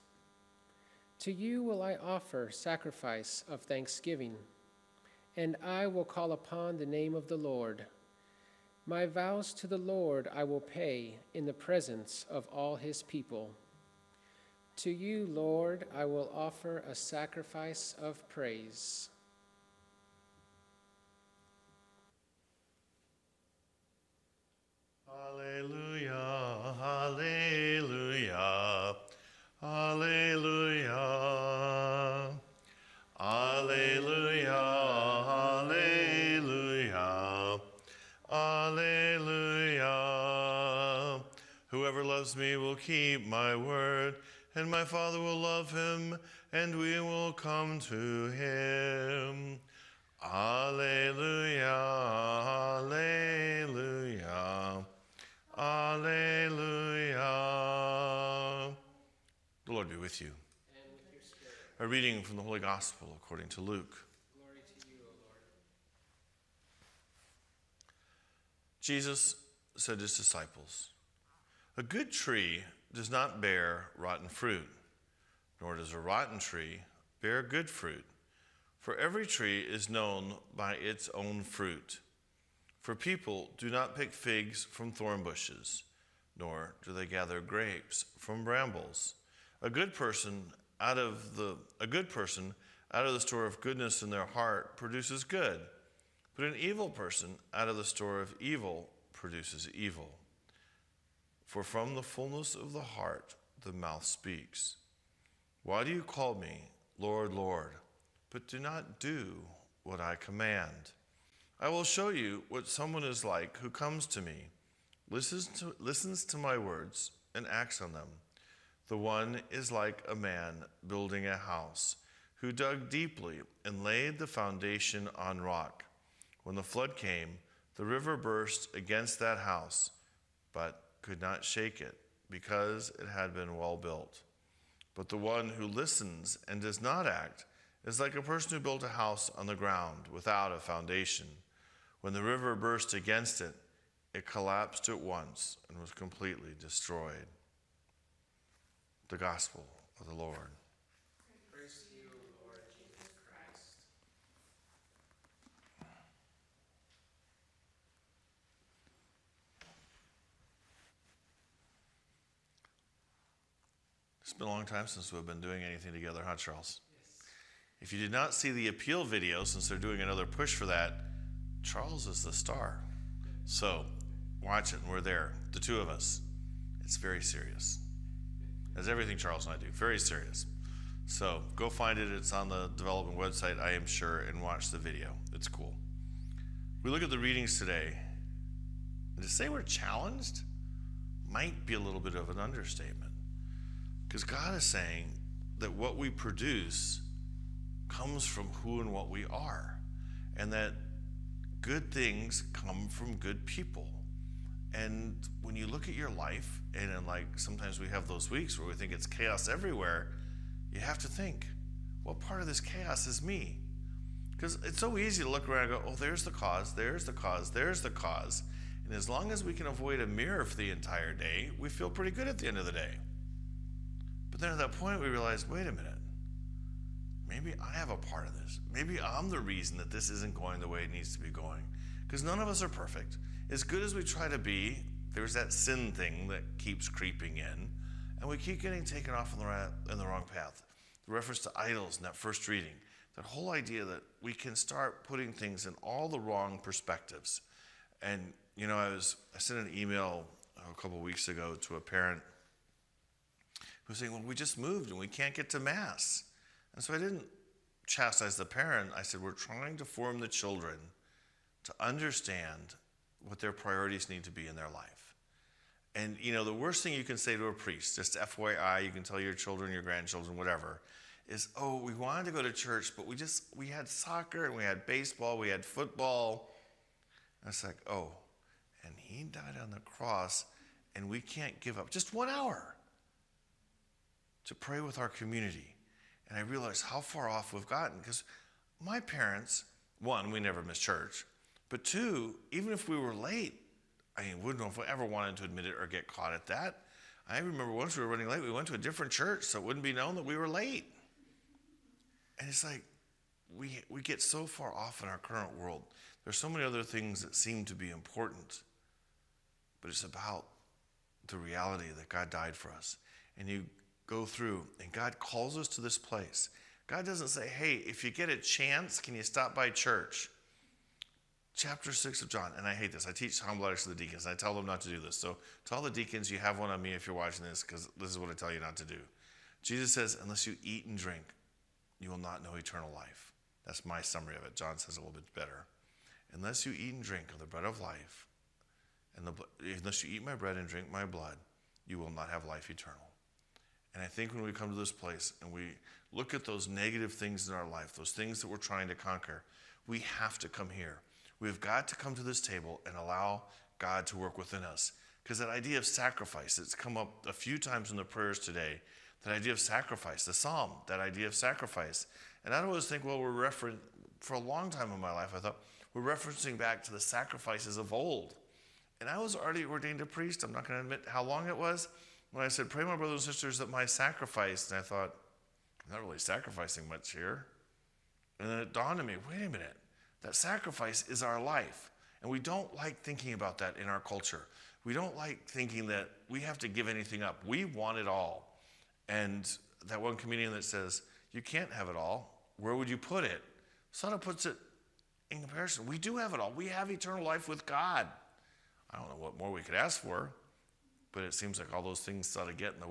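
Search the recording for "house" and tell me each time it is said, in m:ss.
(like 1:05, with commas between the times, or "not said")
2:01, 2:09, 2:18.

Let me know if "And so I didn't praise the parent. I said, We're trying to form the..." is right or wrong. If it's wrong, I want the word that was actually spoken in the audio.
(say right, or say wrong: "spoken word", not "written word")
wrong: "chastise", not "praise".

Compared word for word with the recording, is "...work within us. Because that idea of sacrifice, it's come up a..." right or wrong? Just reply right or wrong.
right.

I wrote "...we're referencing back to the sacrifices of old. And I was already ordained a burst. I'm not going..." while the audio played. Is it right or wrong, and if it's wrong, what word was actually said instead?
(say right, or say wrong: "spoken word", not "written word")
wrong: "priest", not "burst".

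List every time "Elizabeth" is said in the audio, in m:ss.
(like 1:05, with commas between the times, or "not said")
not said.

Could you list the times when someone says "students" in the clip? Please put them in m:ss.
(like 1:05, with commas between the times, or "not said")
not said.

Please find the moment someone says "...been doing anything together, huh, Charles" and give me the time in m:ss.
2:45.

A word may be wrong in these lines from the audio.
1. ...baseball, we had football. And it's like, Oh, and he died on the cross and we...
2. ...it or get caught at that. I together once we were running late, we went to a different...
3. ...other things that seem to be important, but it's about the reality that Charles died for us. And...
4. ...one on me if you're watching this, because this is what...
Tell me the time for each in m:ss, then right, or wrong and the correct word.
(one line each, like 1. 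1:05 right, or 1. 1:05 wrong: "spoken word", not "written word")
1. 4:34 right
2. 4:55 wrong: "remember", not "together"
3. 5:06 wrong: "God", not "Charles"
4. 5:26 right.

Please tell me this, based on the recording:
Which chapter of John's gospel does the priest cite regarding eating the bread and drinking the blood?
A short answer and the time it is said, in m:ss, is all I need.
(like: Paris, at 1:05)
Chapter 6, at 5:21.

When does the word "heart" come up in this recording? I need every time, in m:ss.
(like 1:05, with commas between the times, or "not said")
1:34, 1:42.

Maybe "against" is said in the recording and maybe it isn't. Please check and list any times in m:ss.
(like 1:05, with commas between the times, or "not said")
2:08, 2:22.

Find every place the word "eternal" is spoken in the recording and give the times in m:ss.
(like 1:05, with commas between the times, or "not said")
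5:32, 5:42, 6:36.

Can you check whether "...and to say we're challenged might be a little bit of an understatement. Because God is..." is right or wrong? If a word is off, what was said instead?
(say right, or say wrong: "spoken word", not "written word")
right.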